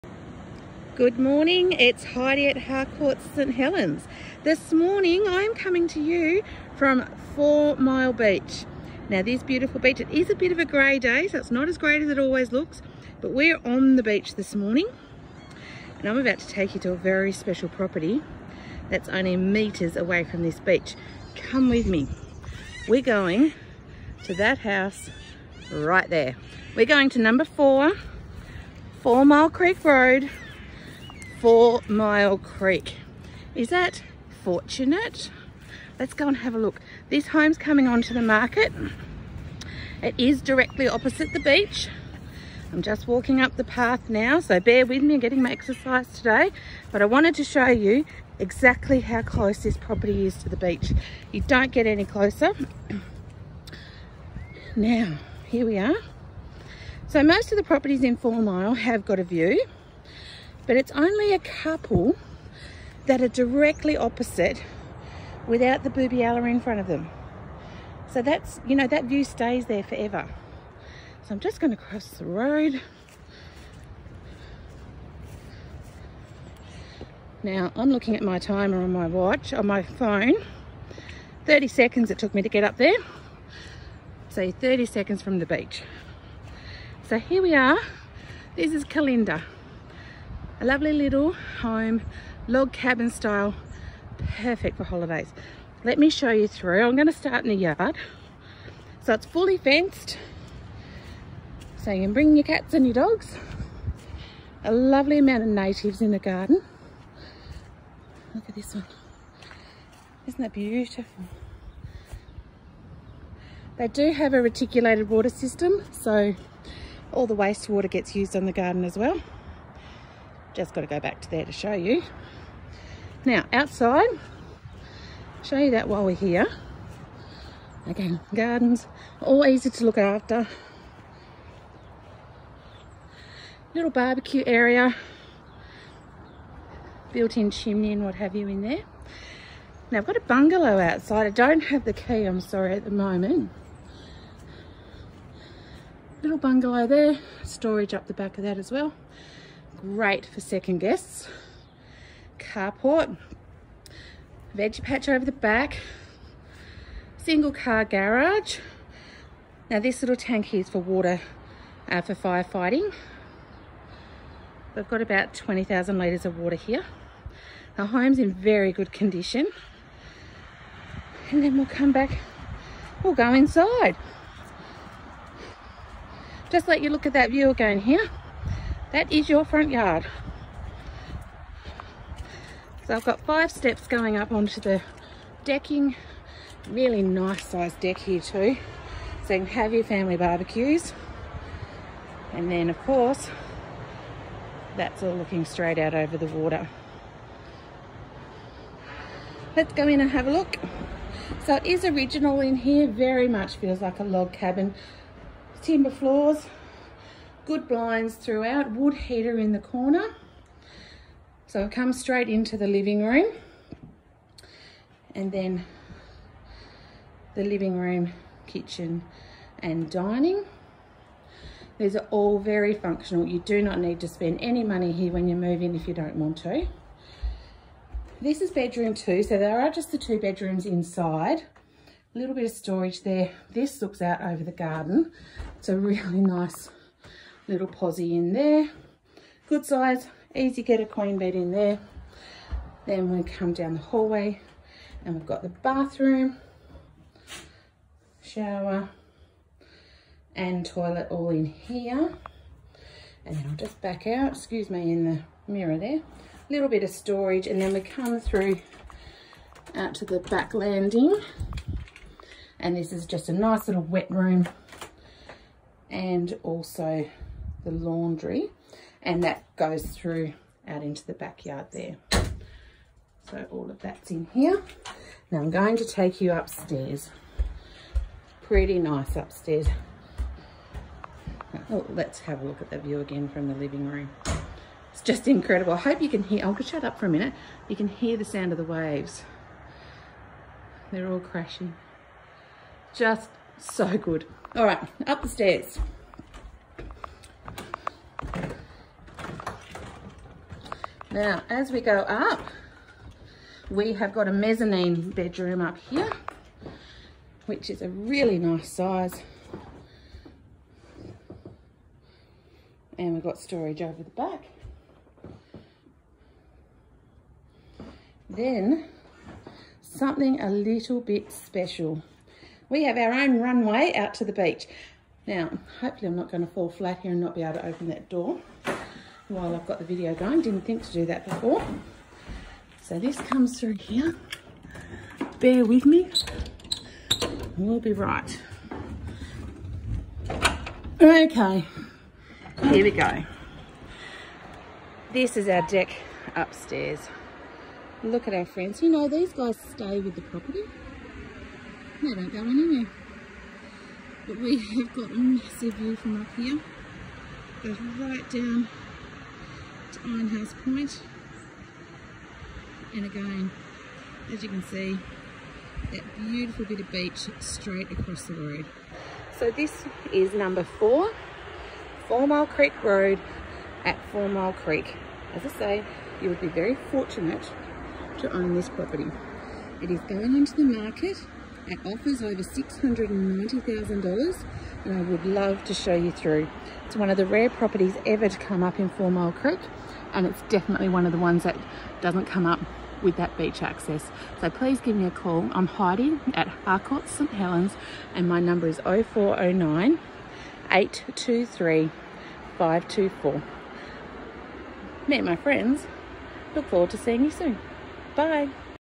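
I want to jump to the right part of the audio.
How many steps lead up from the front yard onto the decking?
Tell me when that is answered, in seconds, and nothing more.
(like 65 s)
183 s.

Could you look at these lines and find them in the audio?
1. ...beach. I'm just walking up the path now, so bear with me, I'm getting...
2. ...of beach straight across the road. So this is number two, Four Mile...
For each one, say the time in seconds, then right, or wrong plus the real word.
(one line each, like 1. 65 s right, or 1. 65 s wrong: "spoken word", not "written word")
1. 41 s right
2. 366 s wrong: "four", not "two".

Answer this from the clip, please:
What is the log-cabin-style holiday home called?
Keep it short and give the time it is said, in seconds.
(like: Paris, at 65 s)
Kalinda, at 88 s.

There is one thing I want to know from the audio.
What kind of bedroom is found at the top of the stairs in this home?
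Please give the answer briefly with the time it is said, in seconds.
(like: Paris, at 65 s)
mezzanine bedroom, at 304 s.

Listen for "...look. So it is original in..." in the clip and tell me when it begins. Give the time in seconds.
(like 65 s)
200 s.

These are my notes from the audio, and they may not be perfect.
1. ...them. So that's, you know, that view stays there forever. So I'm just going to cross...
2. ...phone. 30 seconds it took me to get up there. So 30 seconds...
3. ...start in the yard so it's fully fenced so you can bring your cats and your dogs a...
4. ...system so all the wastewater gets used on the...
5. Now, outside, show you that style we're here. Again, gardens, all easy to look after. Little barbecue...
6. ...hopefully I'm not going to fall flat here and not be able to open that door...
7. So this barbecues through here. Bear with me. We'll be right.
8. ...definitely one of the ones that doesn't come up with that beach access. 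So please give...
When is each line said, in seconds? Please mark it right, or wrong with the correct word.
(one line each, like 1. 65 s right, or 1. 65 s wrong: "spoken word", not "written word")
1. 66 s right
2. 79 s right
3. 97 s right
4. 115 s right
5. 123 s wrong: "while", not "style"
6. 325 s right
7. 332 s wrong: "comes", not "barbecues"
8. 390 s right.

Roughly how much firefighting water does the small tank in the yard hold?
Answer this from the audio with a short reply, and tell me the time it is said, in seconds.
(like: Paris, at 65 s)
20,000 litres, at 165 s.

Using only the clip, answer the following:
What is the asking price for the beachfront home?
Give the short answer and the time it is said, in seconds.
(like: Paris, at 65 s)
offers over $690,000, at 381 s.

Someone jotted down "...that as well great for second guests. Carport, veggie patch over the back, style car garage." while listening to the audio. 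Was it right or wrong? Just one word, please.
wrong.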